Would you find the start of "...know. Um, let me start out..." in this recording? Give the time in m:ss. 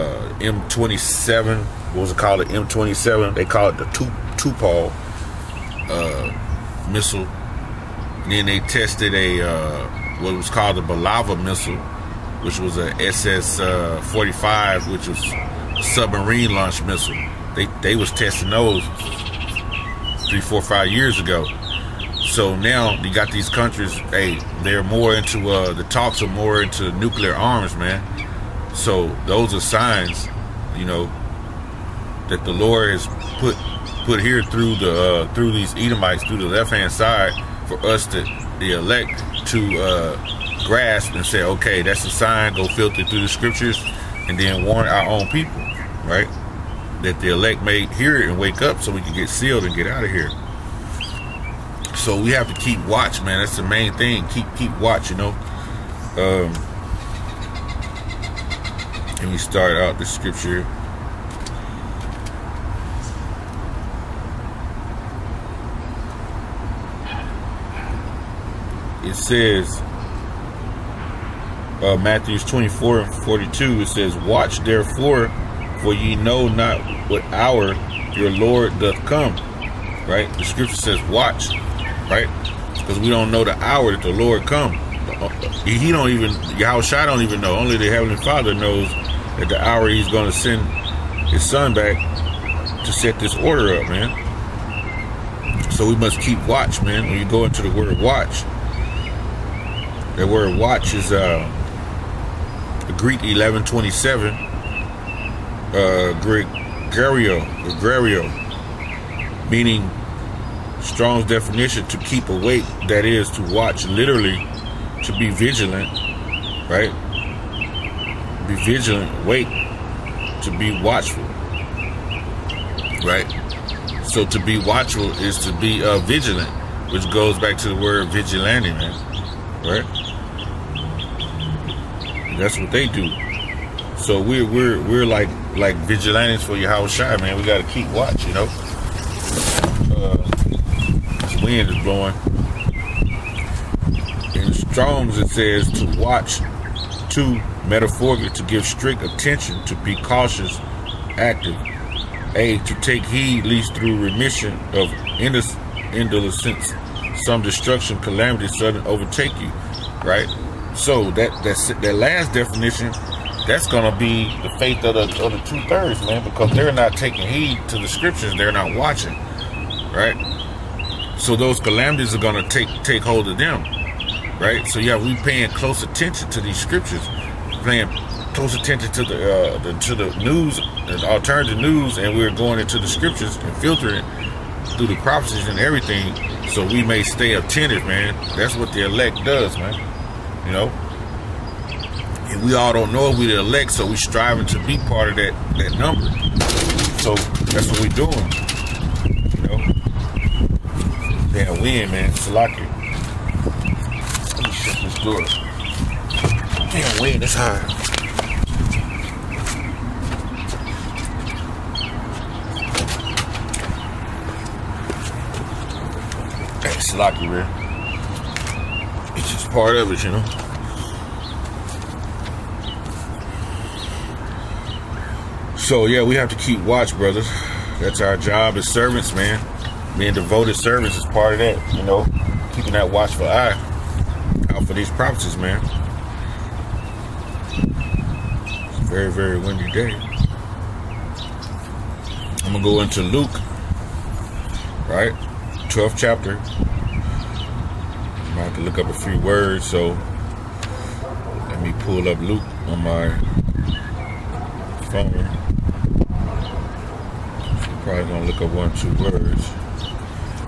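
0:55.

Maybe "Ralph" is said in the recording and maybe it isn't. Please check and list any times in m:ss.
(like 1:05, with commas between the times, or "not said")
not said.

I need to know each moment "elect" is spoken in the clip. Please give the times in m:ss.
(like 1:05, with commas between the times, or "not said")
0:38, 0:47, 3:08, 3:13.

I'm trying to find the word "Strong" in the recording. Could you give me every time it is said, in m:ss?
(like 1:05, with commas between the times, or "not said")
1:50, 2:24.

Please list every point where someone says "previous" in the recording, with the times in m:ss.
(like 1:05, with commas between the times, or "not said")
not said.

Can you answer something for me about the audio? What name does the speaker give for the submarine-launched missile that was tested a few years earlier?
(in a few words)
Bulava.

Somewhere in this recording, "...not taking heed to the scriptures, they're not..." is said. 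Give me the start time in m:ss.
2:46.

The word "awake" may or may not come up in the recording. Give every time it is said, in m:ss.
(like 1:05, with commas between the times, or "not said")
1:52, 1:59.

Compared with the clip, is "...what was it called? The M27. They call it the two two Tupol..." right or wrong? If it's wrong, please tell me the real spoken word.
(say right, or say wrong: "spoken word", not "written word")
right.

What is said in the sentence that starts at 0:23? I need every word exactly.
Hey, they're more into uh, the talks are more into nuclear arms, man.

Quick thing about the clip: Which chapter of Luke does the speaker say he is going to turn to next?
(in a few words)
12.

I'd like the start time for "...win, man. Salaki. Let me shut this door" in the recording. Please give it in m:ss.
3:21.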